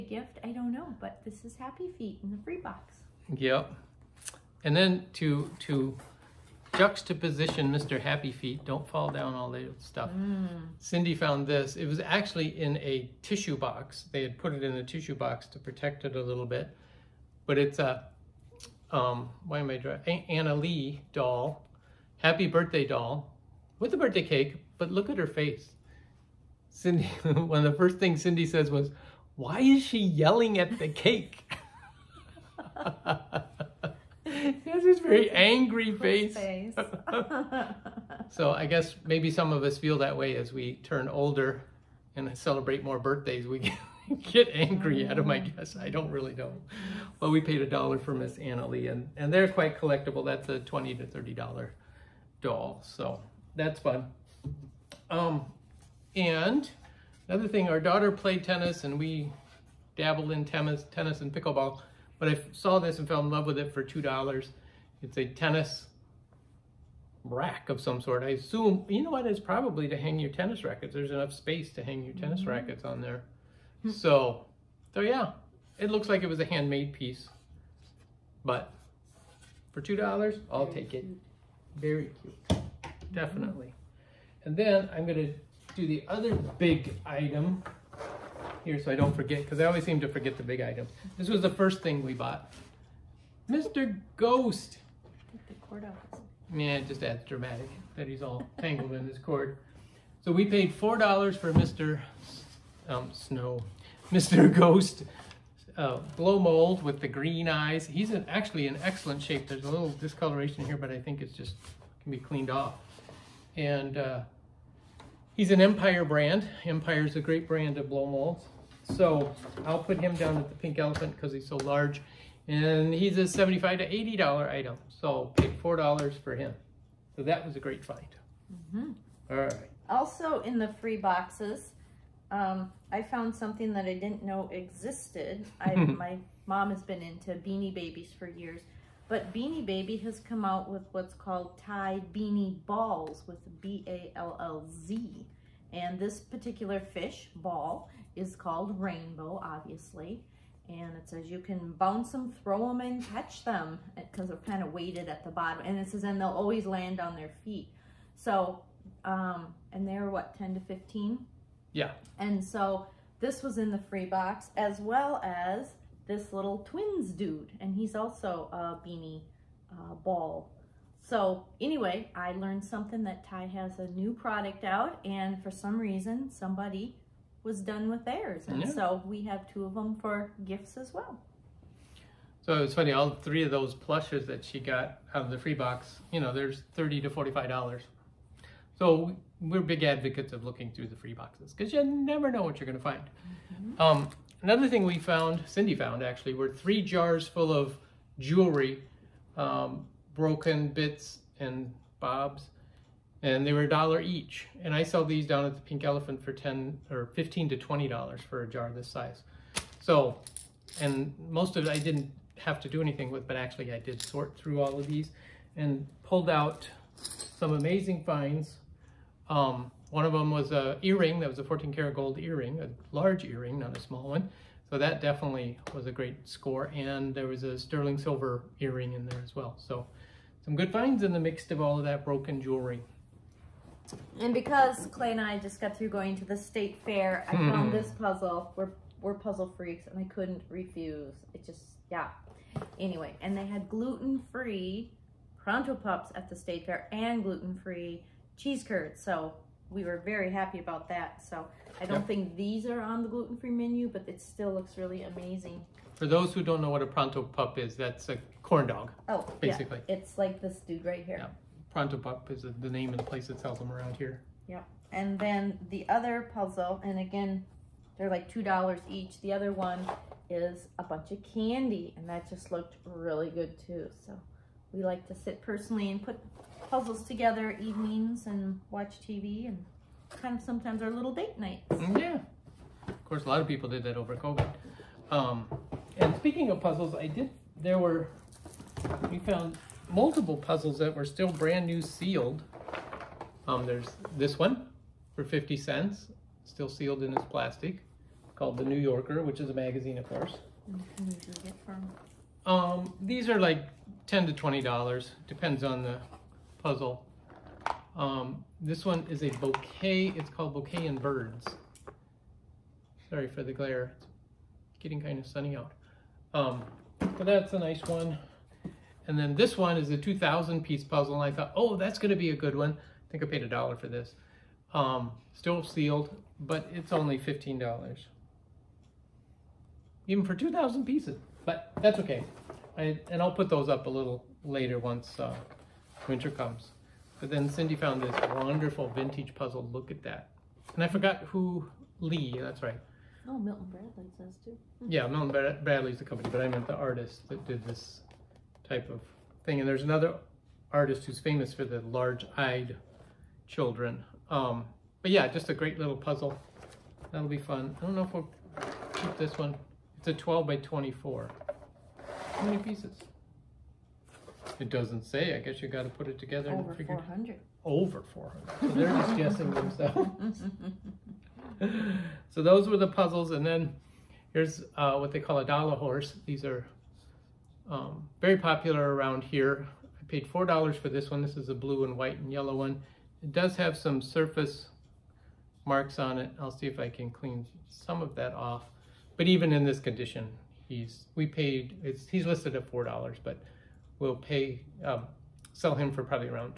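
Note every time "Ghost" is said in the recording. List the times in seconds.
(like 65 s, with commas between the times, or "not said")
94 s, 104 s.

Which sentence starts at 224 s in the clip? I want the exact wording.
So that definitely was a great score.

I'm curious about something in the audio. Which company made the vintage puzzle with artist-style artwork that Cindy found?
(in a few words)
Milton Bradley.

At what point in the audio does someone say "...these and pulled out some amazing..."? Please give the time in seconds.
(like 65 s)
214 s.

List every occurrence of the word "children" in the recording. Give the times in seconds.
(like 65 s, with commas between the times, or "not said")
353 s.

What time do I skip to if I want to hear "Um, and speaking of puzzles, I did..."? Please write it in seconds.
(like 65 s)
285 s.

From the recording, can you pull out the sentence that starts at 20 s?
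Annalee doll, Happy Birthday doll with a birthday cake, but look at her face.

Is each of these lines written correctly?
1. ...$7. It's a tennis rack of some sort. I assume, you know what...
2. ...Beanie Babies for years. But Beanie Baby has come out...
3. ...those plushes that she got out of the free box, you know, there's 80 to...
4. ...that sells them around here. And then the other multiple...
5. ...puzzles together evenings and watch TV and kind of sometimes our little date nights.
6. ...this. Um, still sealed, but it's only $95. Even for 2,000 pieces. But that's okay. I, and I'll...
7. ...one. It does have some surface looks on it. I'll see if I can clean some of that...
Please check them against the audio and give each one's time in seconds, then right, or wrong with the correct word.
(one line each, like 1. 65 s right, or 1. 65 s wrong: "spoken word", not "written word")
1. 63 s wrong: "2", not "7"
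2. 137 s right
3. 183 s wrong: "30", not "80"
4. 263 s wrong: "puzzle", not "multiple"
5. 276 s right
6. 323 s wrong: "15", not "95"
7. 382 s wrong: "marks", not "looks".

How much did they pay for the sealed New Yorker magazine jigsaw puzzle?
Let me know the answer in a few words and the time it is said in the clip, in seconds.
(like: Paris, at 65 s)
50 cents, at 295 s.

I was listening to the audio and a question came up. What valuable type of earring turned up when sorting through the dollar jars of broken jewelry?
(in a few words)
14 karat gold.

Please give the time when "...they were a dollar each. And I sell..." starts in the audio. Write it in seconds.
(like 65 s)
203 s.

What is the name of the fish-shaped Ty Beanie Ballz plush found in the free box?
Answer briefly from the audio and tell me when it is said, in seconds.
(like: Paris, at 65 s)
Rainbow, at 148 s.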